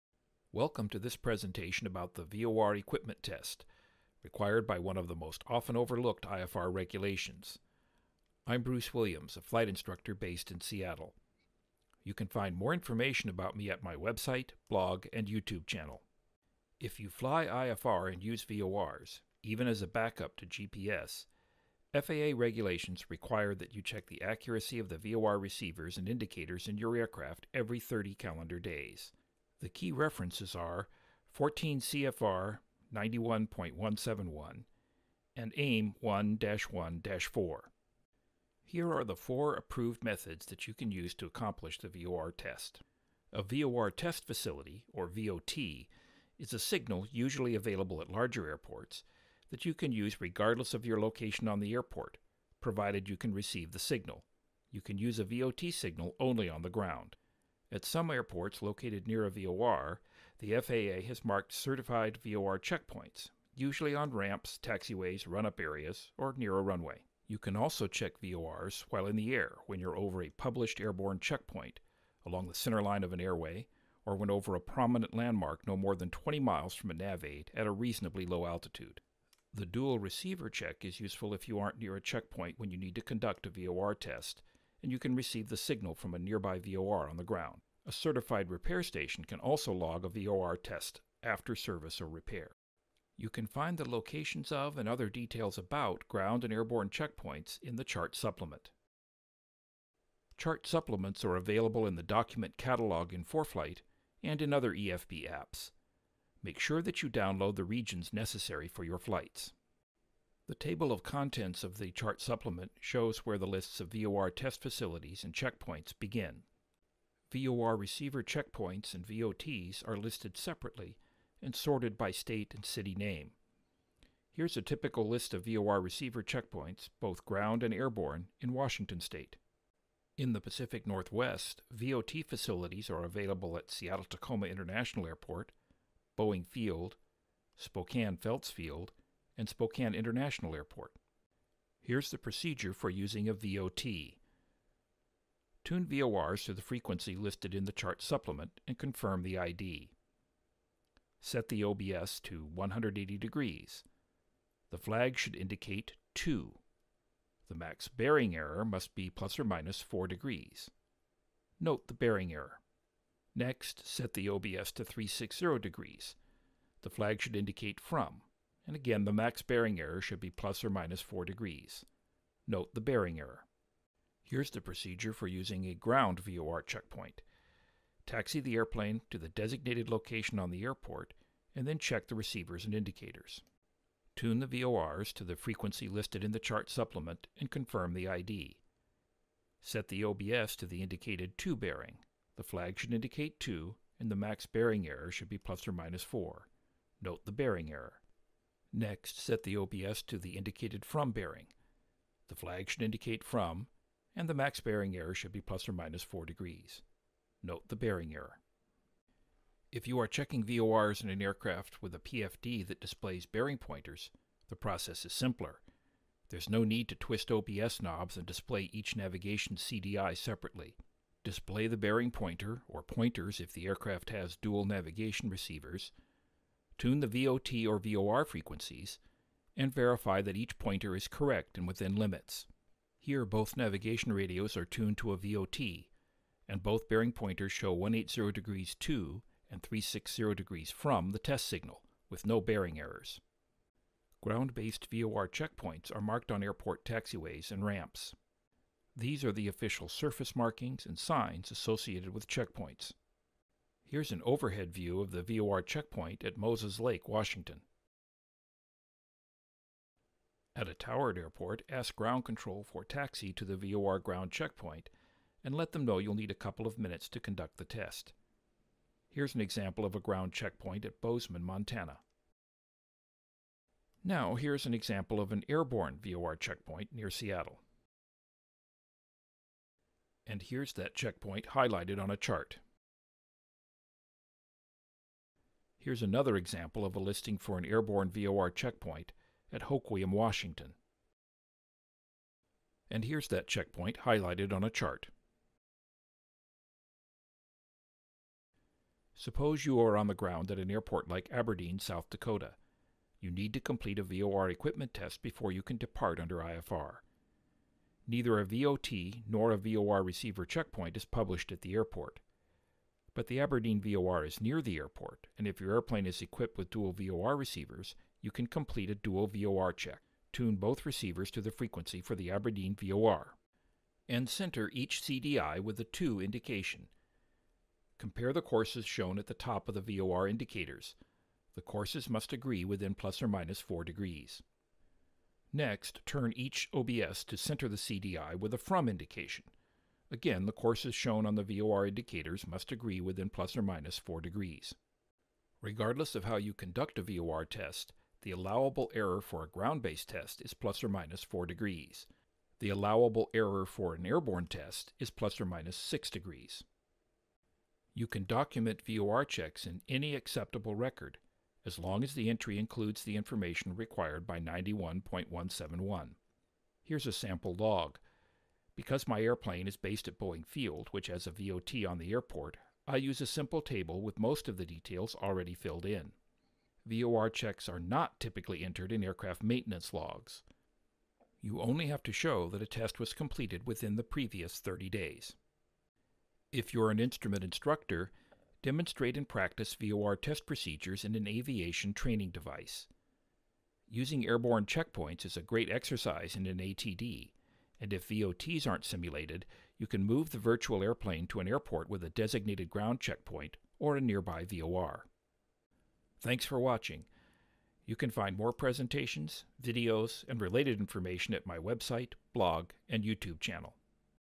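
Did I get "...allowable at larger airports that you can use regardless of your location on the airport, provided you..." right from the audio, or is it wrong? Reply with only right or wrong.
wrong.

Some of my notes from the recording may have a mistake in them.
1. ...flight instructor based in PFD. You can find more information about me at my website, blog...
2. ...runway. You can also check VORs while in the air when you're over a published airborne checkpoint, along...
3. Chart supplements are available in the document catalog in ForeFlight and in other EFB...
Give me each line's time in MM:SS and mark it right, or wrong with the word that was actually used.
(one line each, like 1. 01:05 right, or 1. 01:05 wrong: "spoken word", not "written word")
1. 00:09 wrong: "Seattle", not "PFD"
2. 01:06 right
3. 01:40 right.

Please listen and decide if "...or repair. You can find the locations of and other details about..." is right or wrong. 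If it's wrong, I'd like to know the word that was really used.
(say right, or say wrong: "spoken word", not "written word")
right.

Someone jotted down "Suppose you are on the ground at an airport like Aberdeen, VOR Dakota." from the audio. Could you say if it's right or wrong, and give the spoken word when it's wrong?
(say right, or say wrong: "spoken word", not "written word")
wrong: "South", not "VOR".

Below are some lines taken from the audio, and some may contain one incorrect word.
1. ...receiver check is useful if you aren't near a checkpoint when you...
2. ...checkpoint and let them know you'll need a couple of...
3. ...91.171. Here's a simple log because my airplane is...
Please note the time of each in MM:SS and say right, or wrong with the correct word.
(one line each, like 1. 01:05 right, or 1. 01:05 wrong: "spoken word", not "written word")
1. 01:19 right
2. 04:24 right
3. 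06:04 wrong: "sample", not "simple".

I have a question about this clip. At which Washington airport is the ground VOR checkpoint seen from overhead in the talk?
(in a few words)
Moses Lake.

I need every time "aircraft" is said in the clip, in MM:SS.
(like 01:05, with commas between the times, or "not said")
00:26, 03:31, 03:43, 06:19.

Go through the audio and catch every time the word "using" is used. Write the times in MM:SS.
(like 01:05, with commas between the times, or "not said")
02:22, 02:55, 06:33.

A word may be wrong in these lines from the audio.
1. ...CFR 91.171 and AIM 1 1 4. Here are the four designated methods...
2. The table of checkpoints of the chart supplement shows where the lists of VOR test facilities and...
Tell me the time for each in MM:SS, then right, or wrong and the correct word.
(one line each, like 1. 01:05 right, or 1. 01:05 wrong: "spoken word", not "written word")
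1. 00:31 wrong: "approved", not "designated"
2. 01:50 wrong: "contents", not "checkpoints".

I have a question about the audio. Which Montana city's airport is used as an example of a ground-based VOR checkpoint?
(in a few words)
Bozeman.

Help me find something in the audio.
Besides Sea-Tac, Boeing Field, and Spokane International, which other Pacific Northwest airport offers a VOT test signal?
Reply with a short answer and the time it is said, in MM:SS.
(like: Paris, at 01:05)
Spokane Felts Field, at 02:17.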